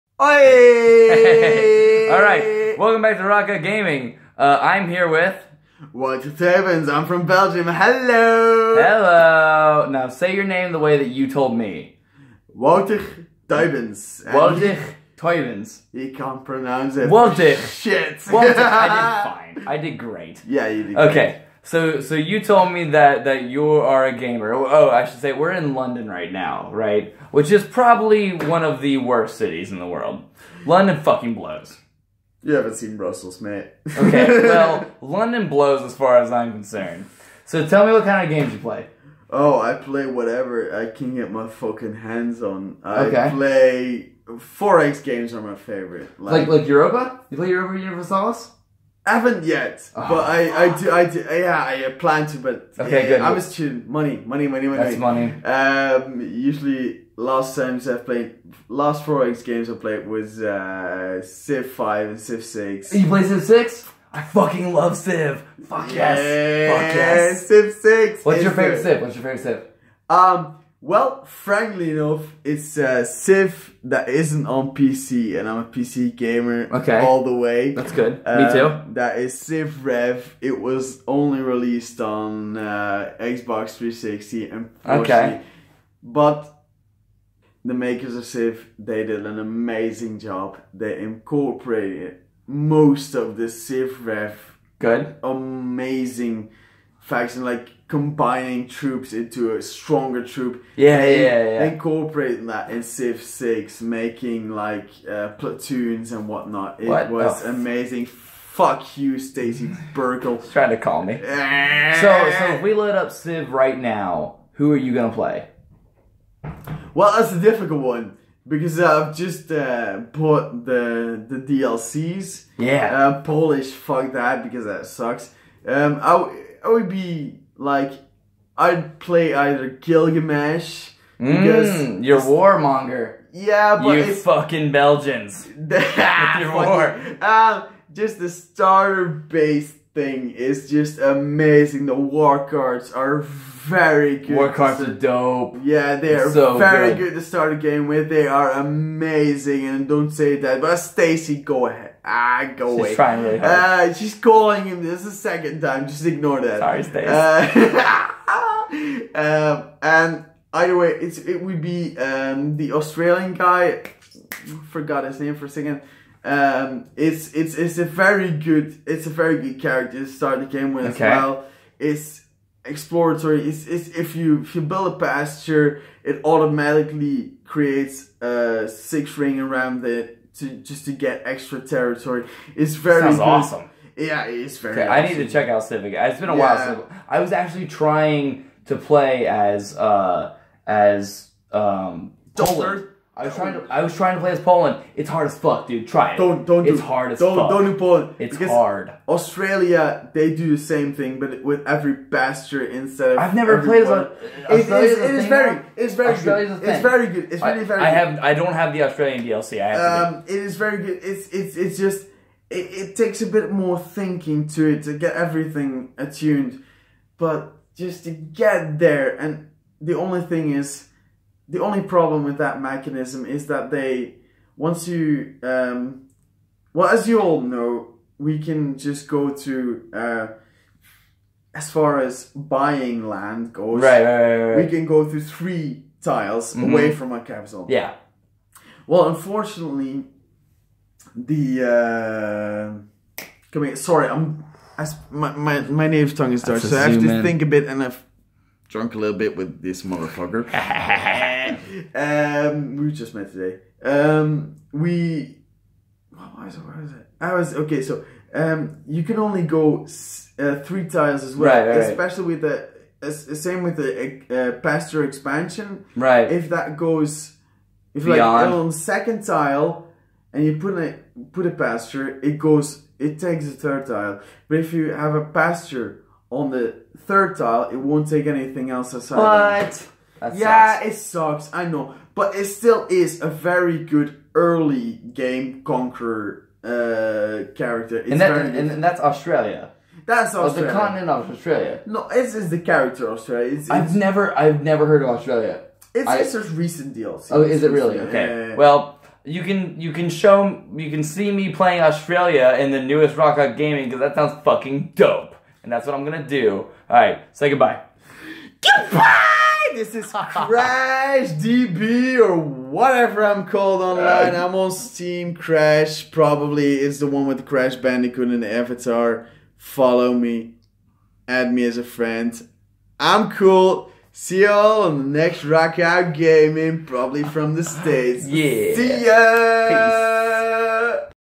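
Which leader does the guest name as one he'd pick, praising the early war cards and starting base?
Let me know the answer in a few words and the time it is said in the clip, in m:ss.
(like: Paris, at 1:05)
Gilgamesh, at 2:09.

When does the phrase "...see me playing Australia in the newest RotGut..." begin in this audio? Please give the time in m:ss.
5:01.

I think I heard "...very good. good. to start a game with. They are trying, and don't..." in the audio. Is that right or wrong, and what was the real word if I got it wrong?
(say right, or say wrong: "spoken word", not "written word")
wrong: "amazing", not "trying".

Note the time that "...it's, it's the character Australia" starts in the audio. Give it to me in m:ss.
4:52.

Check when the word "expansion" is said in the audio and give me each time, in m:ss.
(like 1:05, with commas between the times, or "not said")
4:25.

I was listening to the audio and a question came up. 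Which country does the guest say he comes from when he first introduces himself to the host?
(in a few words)
Belgium.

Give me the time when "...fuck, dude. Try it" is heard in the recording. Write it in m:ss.
3:15.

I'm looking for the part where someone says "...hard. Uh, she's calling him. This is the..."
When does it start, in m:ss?
2:33.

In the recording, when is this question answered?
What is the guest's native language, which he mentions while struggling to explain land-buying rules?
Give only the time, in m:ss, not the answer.
4:06.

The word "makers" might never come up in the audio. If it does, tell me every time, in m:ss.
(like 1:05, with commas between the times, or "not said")
1:27.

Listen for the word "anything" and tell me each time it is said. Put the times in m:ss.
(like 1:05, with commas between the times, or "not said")
4:38.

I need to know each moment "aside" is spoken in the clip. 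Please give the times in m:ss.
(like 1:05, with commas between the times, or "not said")
4:38.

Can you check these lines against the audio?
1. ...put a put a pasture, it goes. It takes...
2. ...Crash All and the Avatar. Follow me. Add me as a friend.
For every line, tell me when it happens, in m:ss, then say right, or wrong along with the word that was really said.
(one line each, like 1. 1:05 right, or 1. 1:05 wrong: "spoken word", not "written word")
1. 4:30 right
2. 5:17 wrong: "Bandicoot", not "All".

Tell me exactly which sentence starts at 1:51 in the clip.
so, so if we load up Civ right now, who are you gonna play?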